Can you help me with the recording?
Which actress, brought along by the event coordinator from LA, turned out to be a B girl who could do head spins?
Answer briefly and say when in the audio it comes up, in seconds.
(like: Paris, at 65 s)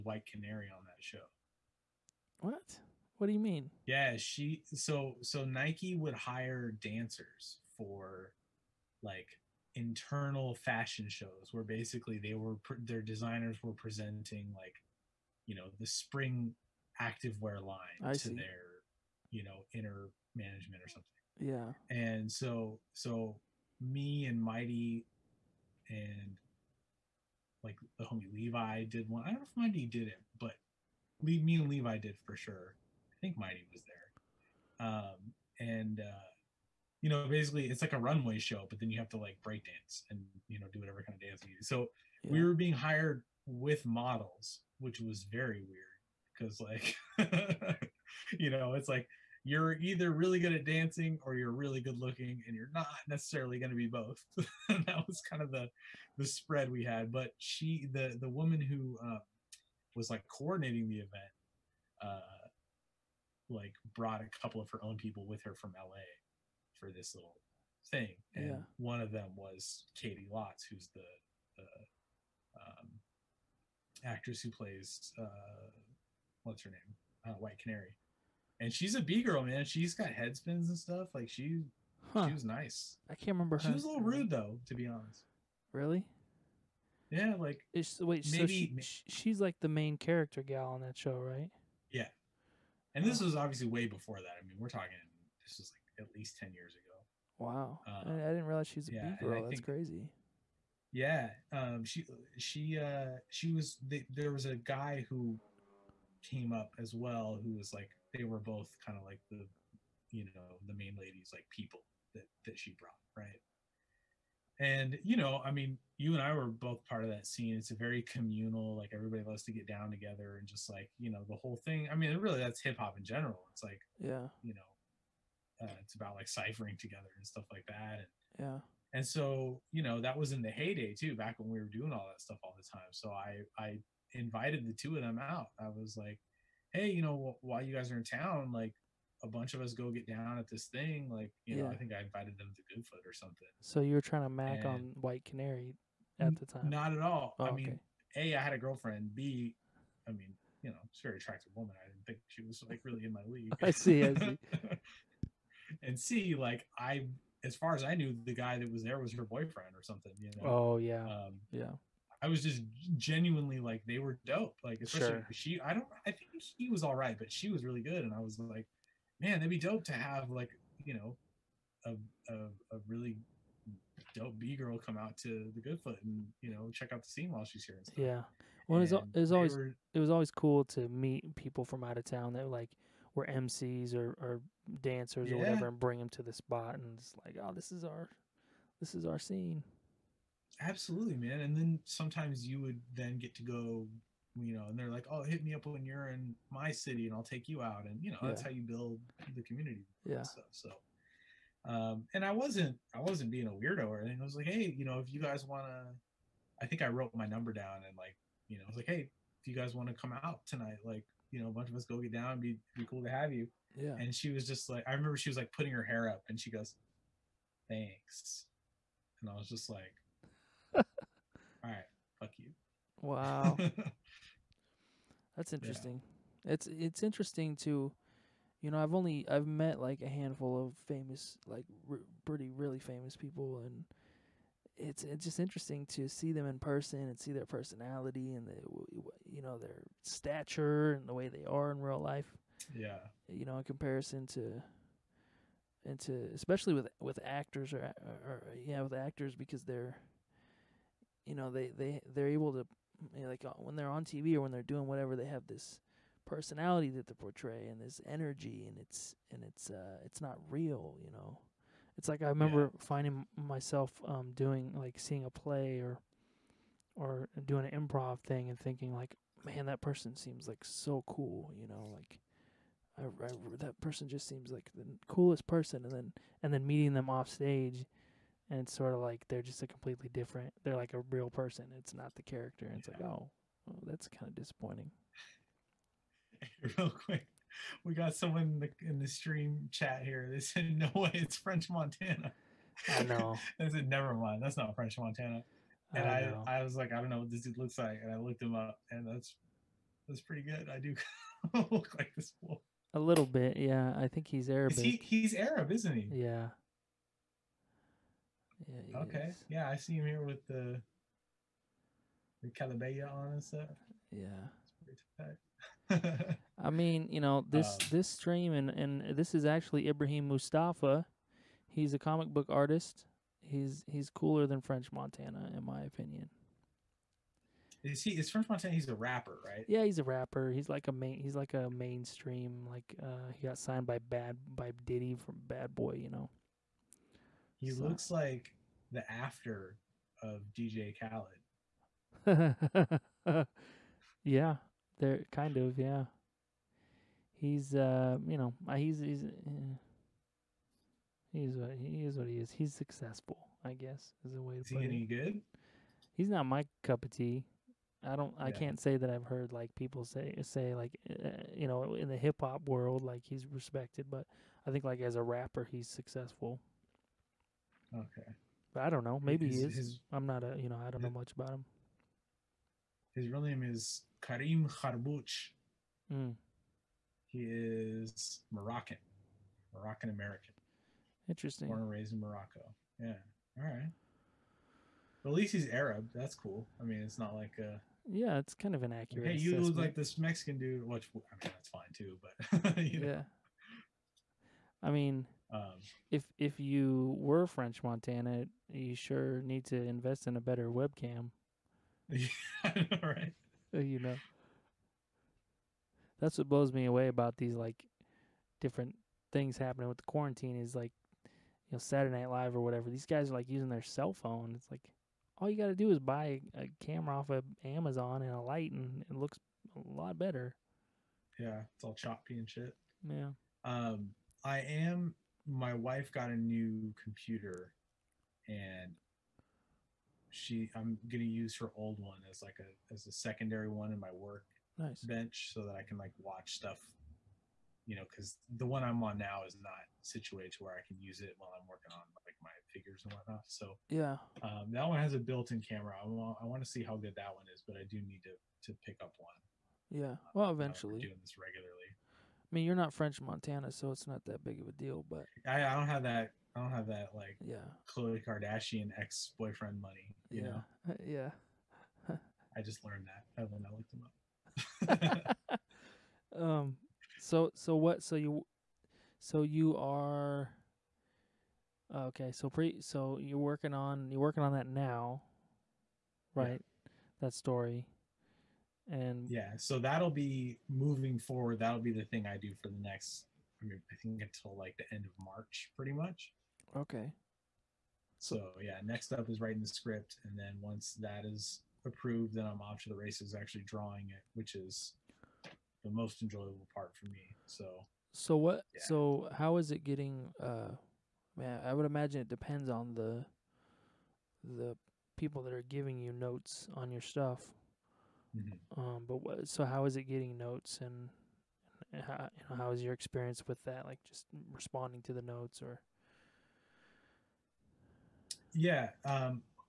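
Caity Lotz, at 69 s.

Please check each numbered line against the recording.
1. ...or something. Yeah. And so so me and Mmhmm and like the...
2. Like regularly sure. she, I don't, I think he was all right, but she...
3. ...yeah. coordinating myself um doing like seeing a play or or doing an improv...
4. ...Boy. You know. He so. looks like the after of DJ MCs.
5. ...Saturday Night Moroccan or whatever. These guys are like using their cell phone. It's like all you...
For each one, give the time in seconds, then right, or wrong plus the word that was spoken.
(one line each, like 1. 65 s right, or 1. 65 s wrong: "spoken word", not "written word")
1. 20 s wrong: "Mighty", not "Mmhmm"
2. 164 s wrong: "especially", not "regularly"
3. 262 s wrong: "finding", not "coordinating"
4. 335 s wrong: "Khaled", not "MCs"
5. 411 s wrong: "Live", not "Moroccan".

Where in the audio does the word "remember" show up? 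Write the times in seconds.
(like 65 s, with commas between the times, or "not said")
83 s, 214 s, 262 s.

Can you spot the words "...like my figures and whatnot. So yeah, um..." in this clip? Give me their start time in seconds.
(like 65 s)
442 s.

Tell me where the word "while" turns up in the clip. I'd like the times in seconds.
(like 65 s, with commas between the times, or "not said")
137 s, 177 s, 441 s.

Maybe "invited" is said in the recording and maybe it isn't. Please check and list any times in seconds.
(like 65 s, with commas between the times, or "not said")
134 s, 142 s.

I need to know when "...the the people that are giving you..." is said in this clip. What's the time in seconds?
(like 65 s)
502 s.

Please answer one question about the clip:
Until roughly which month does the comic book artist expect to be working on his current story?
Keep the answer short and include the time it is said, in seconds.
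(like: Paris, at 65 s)
March, at 485 s.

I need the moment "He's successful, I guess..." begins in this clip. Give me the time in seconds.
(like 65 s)
352 s.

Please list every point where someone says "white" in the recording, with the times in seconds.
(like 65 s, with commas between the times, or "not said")
0 s, 77 s, 145 s.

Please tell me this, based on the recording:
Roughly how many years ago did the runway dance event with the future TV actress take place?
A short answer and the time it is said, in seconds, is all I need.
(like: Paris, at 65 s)
10, at 96 s.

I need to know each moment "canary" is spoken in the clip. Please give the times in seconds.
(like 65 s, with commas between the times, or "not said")
0 s, 77 s, 145 s.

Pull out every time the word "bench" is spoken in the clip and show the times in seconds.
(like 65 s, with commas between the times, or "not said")
435 s.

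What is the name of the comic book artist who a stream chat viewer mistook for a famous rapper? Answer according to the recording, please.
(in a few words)
Ibrahim Moustafa.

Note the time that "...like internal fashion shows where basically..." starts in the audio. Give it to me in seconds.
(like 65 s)
9 s.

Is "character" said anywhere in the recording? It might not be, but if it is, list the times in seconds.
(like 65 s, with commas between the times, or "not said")
89 s, 282 s.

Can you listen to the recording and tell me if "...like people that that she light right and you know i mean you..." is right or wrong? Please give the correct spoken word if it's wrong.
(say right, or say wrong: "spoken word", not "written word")
wrong: "brought", not "light".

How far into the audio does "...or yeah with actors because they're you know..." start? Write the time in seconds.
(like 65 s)
248 s.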